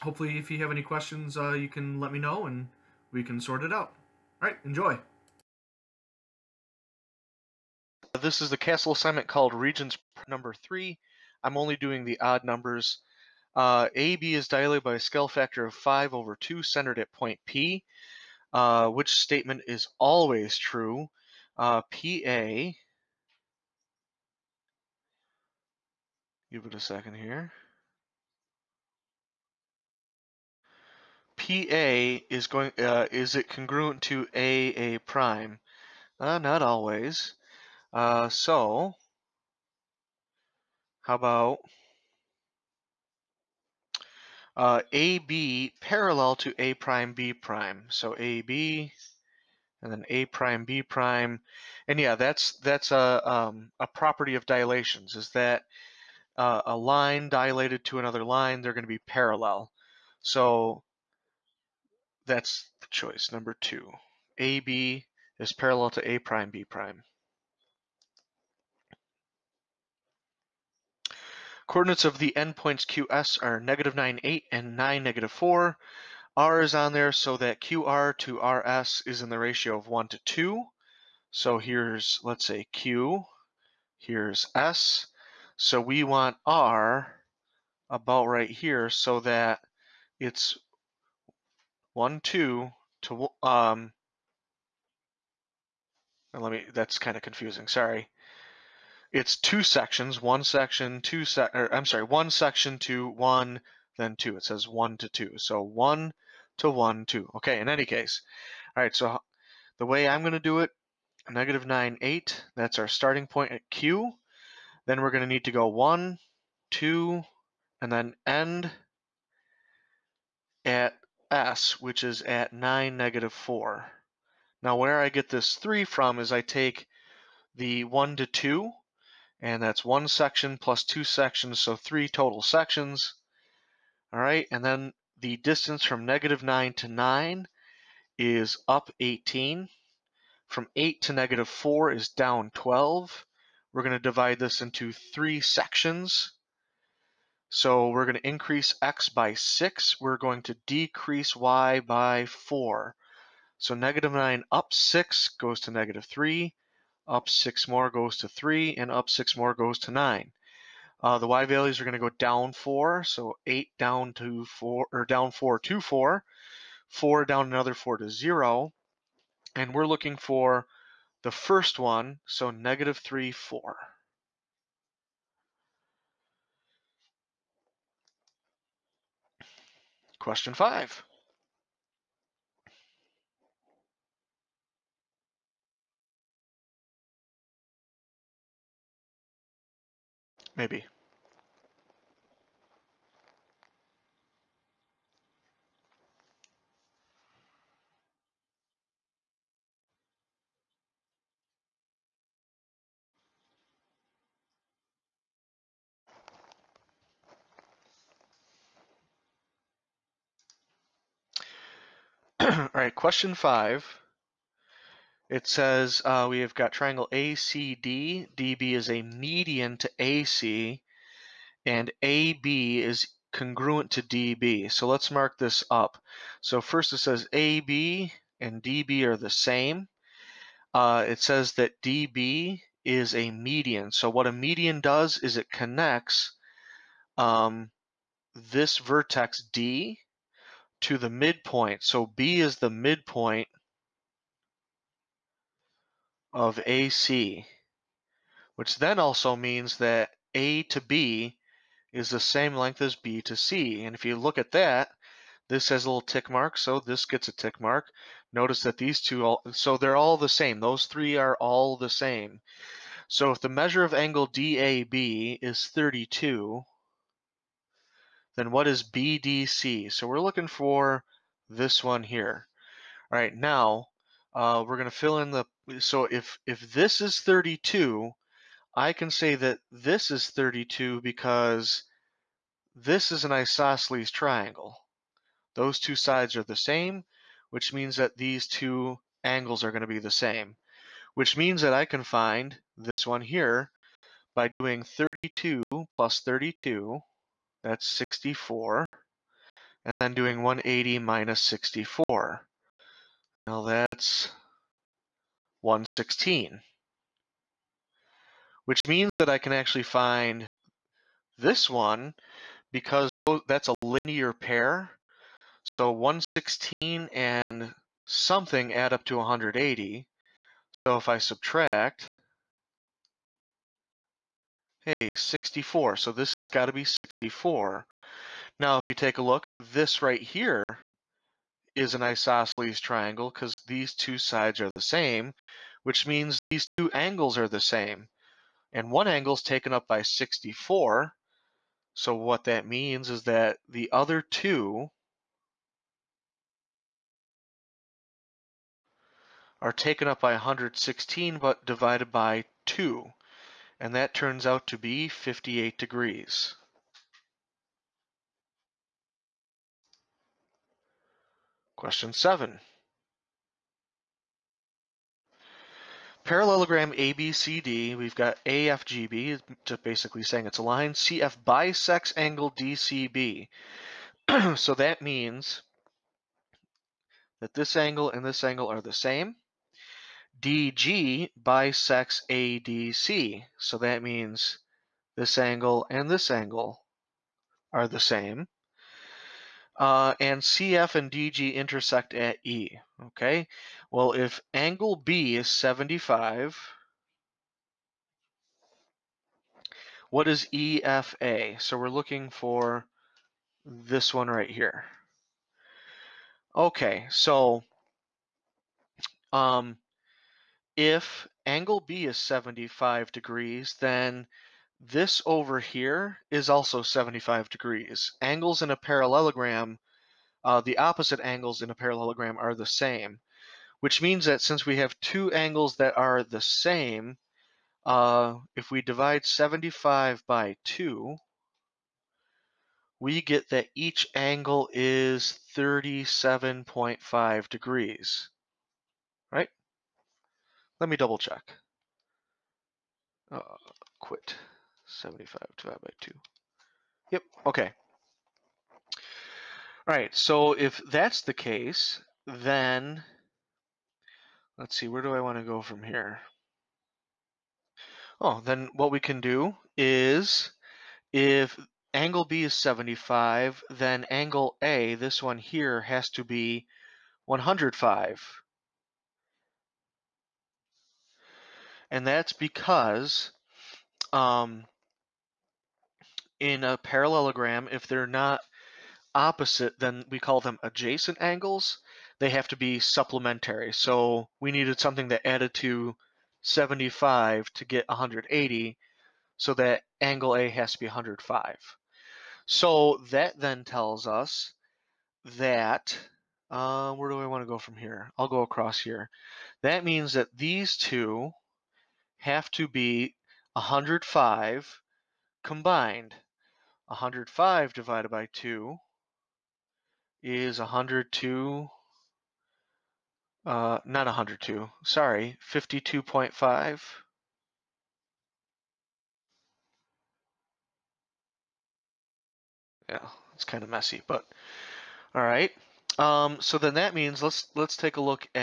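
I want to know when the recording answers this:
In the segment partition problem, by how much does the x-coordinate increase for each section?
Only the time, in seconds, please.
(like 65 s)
148 s.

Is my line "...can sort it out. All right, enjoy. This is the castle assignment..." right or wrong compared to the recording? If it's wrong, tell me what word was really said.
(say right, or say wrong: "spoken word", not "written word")
right.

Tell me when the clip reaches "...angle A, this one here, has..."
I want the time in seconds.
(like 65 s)
464 s.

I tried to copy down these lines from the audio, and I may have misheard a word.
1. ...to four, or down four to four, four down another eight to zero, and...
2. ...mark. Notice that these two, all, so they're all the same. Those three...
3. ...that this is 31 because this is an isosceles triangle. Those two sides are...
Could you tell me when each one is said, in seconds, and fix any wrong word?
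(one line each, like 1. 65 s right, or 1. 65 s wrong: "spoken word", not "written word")
1. 164 s wrong: "four", not "eight"
2. 257 s right
3. 279 s wrong: "32", not "31".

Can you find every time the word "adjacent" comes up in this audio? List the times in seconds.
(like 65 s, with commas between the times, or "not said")
480 s.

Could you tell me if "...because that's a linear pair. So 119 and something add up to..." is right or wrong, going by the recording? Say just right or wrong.
wrong.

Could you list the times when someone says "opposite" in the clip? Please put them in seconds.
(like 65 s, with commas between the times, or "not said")
420 s, 479 s.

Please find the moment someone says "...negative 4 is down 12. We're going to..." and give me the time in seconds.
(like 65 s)
141 s.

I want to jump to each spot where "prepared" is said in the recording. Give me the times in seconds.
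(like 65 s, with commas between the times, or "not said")
not said.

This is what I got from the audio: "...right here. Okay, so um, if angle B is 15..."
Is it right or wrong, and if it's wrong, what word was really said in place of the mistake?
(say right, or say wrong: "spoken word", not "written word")
wrong: "75", not "15".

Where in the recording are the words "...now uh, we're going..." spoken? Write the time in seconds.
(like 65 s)
273 s.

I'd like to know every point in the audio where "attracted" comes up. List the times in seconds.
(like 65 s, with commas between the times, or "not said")
not said.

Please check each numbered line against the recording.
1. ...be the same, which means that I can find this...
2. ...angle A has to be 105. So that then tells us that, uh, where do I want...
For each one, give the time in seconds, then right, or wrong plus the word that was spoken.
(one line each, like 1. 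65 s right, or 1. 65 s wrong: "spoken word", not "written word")
1. 289 s right
2. 490 s right.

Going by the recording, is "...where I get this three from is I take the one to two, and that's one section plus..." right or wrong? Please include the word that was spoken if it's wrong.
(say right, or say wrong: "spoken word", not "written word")
right.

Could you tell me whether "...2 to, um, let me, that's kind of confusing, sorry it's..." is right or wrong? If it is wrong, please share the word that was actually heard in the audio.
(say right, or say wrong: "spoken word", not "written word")
right.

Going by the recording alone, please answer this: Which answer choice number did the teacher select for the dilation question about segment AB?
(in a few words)
2.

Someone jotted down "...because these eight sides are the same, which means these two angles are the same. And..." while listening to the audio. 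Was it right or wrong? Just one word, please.
wrong.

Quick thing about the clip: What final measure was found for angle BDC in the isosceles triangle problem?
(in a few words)
58 degrees.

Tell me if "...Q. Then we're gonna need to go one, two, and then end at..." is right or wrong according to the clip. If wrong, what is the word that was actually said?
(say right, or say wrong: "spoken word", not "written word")
right.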